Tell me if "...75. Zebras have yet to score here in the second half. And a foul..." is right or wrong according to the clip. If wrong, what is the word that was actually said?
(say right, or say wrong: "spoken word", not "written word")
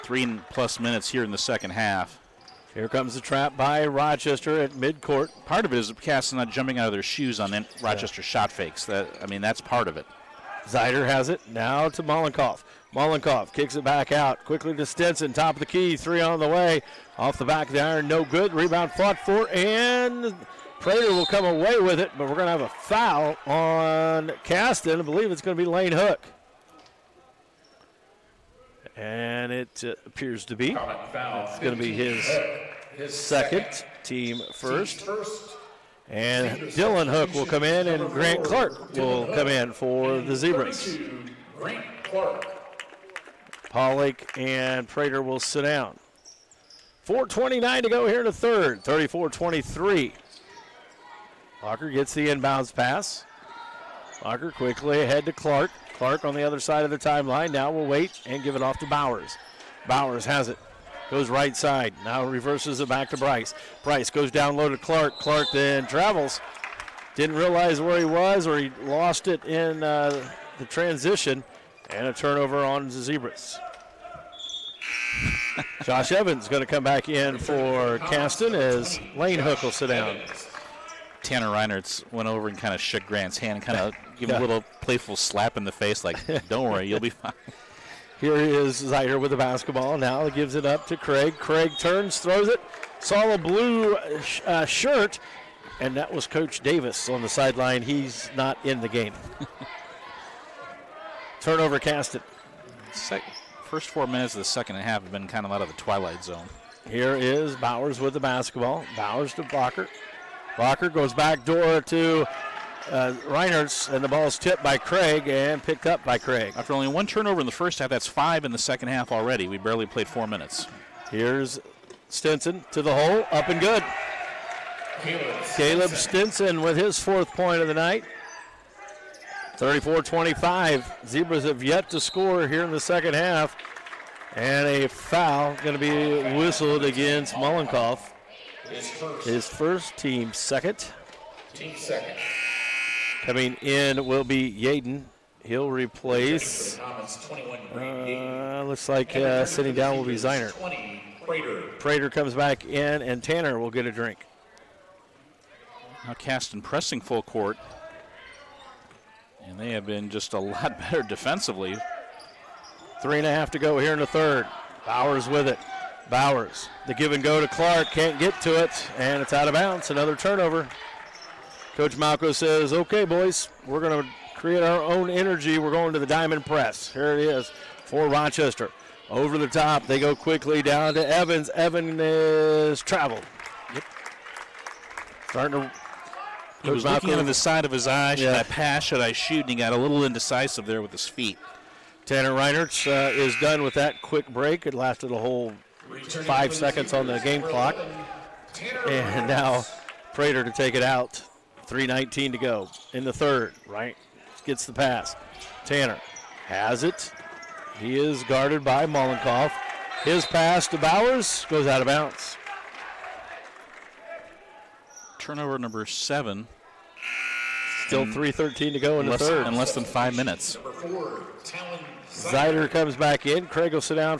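wrong: "25", not "75".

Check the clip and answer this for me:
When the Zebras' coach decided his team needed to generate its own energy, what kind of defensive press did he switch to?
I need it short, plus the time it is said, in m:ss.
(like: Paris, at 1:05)
Diamond press, at 2:56.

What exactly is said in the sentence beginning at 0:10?
Zeider has it now to Mollenkopf.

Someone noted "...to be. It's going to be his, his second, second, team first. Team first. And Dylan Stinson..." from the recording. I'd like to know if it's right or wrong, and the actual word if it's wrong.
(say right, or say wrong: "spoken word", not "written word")
wrong: "Hook", not "Stinson".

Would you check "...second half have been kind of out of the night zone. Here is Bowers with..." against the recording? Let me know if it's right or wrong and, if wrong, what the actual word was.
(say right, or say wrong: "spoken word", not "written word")
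wrong: "twilight", not "night".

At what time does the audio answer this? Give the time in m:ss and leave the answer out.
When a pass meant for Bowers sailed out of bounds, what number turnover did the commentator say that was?
3:35.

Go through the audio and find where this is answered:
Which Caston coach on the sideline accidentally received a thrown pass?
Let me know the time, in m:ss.
1:36.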